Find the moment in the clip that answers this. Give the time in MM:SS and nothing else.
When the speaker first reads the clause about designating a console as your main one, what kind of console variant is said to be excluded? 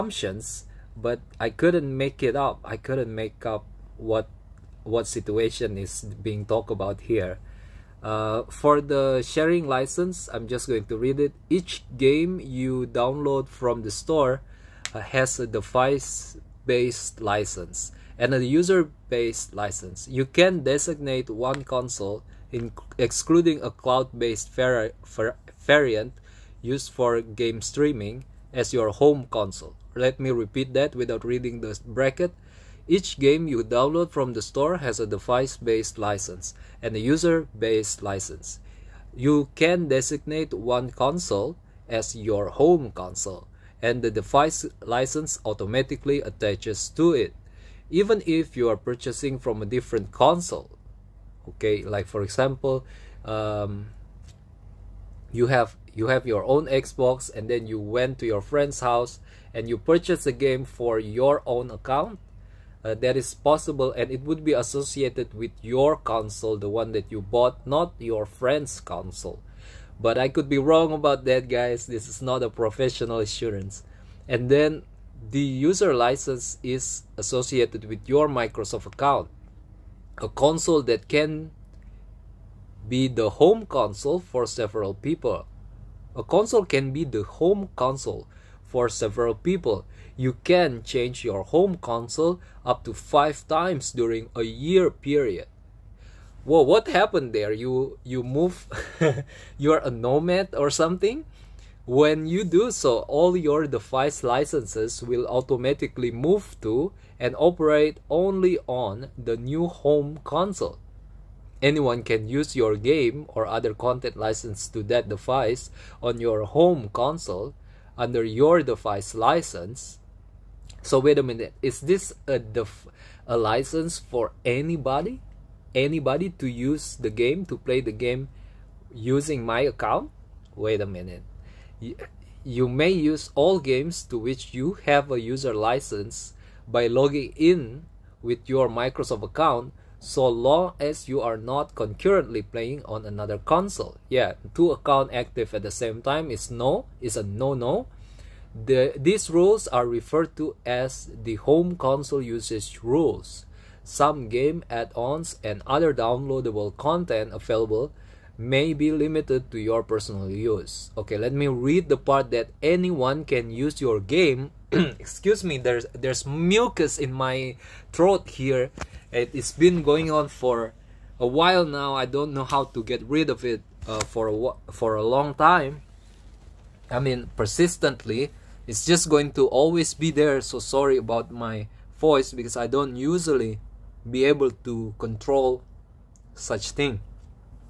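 00:23.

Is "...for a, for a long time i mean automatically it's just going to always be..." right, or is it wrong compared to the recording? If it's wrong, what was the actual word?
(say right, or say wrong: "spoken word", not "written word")
wrong: "persistently", not "automatically".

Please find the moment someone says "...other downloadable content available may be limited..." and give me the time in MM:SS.
02:35.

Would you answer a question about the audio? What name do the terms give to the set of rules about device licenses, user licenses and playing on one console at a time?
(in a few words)
home console usage rules.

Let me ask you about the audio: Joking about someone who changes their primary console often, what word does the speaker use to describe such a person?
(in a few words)
nomad.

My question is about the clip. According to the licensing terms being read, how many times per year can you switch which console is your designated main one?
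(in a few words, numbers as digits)
5.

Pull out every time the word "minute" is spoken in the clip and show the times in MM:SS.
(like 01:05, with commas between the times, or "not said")
02:01, 02:10.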